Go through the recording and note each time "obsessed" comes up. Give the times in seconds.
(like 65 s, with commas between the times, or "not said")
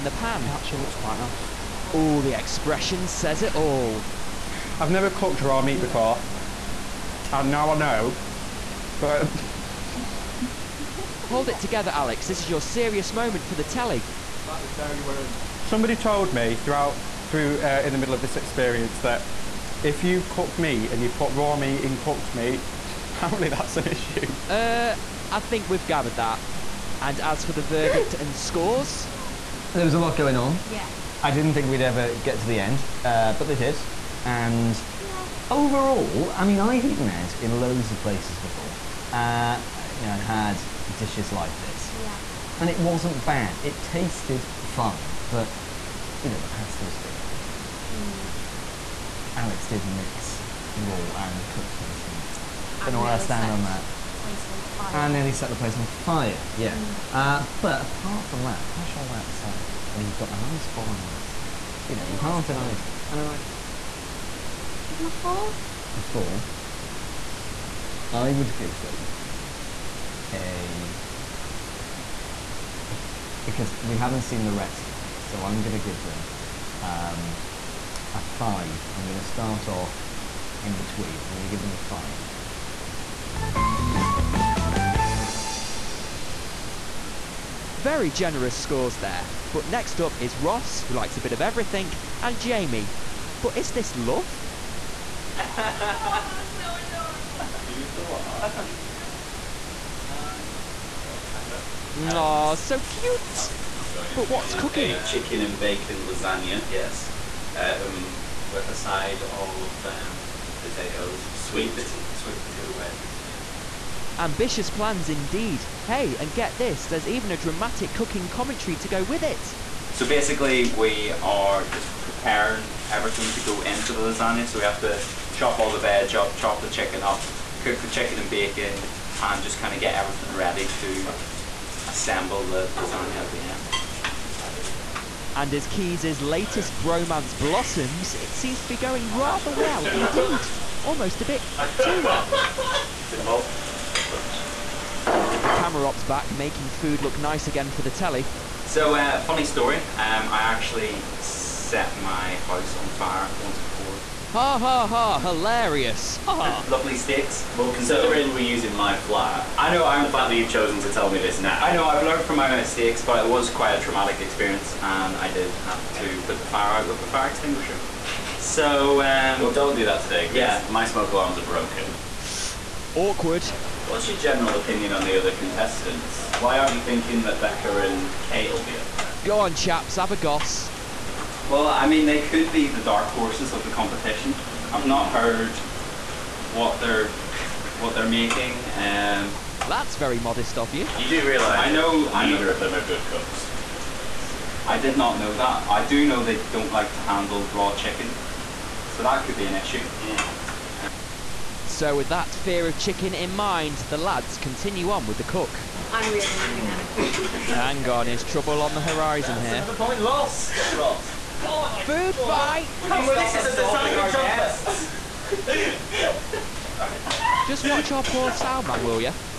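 not said.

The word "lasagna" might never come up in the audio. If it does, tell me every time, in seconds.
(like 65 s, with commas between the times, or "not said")
106 s, 124 s, 132 s.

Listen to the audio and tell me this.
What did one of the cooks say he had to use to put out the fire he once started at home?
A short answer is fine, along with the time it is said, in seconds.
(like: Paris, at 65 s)
A fire extinguisher, at 167 s.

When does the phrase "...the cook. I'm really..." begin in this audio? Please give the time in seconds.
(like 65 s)
205 s.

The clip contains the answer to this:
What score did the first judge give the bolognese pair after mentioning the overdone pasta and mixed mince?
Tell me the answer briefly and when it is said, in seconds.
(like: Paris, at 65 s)
4, at 64 s.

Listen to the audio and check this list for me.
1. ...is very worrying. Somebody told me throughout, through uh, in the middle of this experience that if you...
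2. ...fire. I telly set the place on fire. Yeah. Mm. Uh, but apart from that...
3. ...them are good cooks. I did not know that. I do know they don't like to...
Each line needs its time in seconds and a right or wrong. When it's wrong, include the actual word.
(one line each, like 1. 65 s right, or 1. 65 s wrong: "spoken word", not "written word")
1. 14 s right
2. 54 s wrong: "nearly", not "telly"
3. 192 s right.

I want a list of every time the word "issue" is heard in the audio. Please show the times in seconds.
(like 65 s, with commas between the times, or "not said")
23 s, 199 s.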